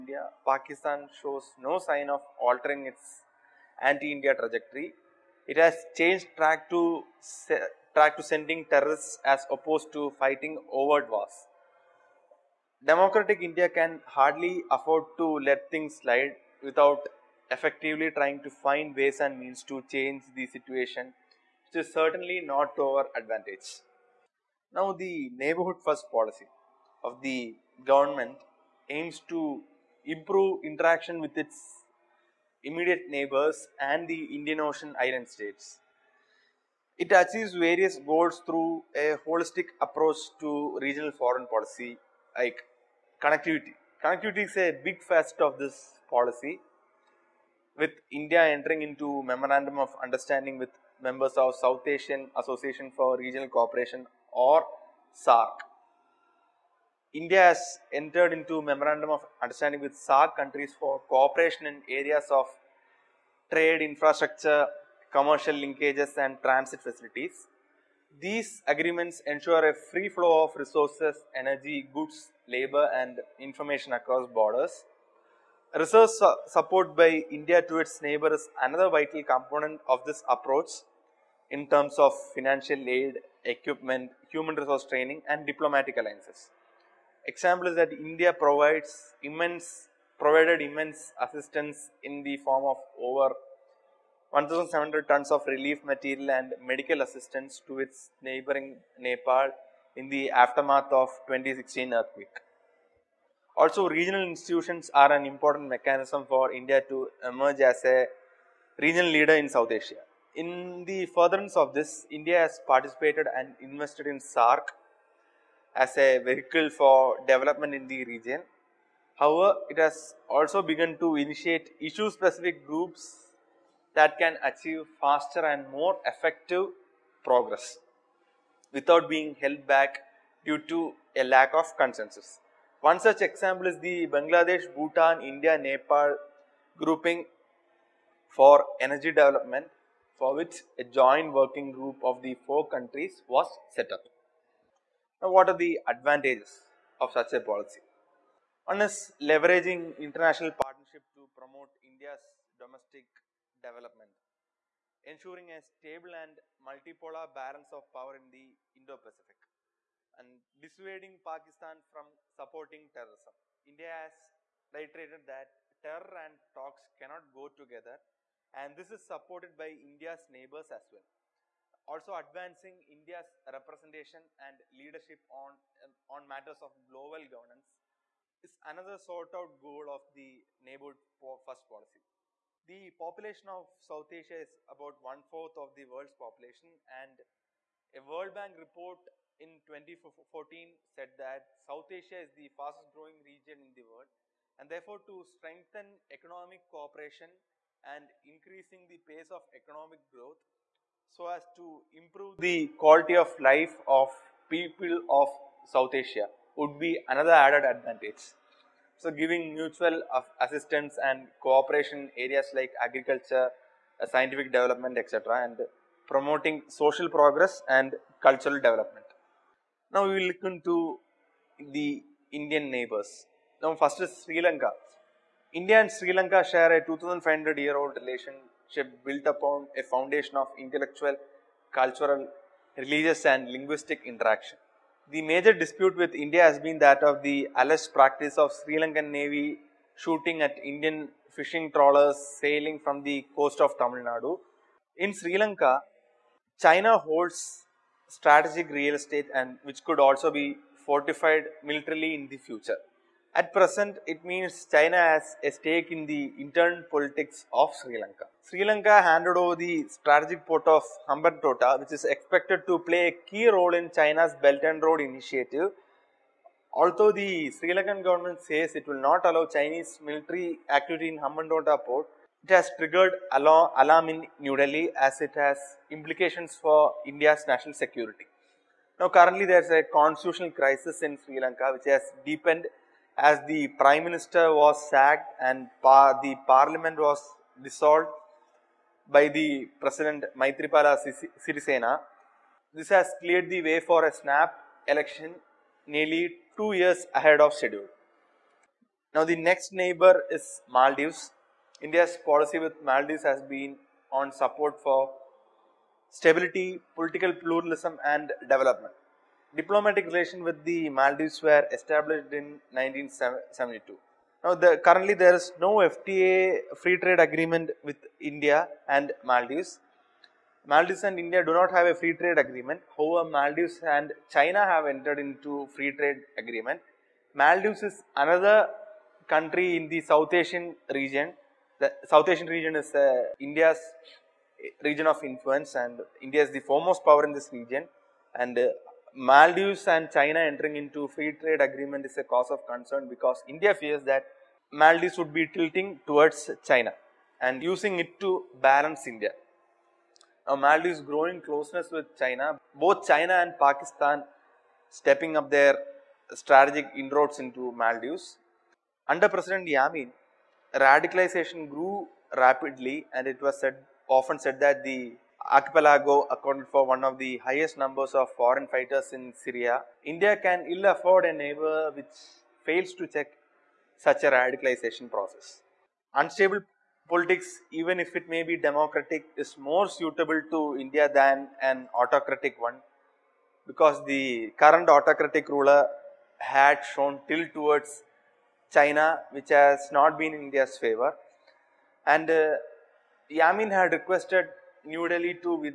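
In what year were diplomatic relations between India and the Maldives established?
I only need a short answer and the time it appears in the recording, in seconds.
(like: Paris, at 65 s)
1972, at 312 s.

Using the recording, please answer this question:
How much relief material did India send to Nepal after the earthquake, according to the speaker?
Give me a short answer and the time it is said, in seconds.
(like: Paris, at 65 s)
over 1700 tons, at 92 s.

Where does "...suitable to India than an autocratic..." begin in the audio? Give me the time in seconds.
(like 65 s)
379 s.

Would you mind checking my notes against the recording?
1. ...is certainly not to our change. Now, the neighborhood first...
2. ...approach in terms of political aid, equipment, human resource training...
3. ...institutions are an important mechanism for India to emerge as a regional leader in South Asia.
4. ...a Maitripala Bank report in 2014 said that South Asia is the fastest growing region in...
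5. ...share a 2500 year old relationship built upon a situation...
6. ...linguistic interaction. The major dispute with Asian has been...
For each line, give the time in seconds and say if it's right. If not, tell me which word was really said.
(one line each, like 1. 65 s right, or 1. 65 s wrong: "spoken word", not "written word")
1. 21 s wrong: "advantage", not "change"
2. 80 s wrong: "financial", not "political"
3. 104 s right
4. 187 s wrong: "World", not "Maitripala"
5. 226 s wrong: "foundation", not "situation"
6. 233 s wrong: "India", not "Asian".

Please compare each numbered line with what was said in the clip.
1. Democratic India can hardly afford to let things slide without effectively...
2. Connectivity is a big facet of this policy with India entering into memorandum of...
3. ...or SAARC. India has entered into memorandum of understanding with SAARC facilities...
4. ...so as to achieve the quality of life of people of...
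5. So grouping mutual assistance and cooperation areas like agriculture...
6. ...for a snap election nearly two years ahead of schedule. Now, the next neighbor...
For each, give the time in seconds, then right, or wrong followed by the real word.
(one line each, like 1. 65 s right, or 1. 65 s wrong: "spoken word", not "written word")
1. 12 s right
2. 44 s right
3. 54 s wrong: "countries", not "facilities"
4. 201 s wrong: "improve", not "achieve"
5. 208 s wrong: "giving", not "grouping"
6. 293 s right.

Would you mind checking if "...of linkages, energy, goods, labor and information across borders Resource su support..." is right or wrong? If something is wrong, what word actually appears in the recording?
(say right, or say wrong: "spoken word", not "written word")
wrong: "resources", not "linkages".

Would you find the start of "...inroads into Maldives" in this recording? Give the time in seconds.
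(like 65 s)
356 s.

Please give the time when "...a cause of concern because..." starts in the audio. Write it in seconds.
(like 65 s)
342 s.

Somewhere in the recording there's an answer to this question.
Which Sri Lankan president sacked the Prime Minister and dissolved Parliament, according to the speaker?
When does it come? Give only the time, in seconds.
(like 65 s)
290 s.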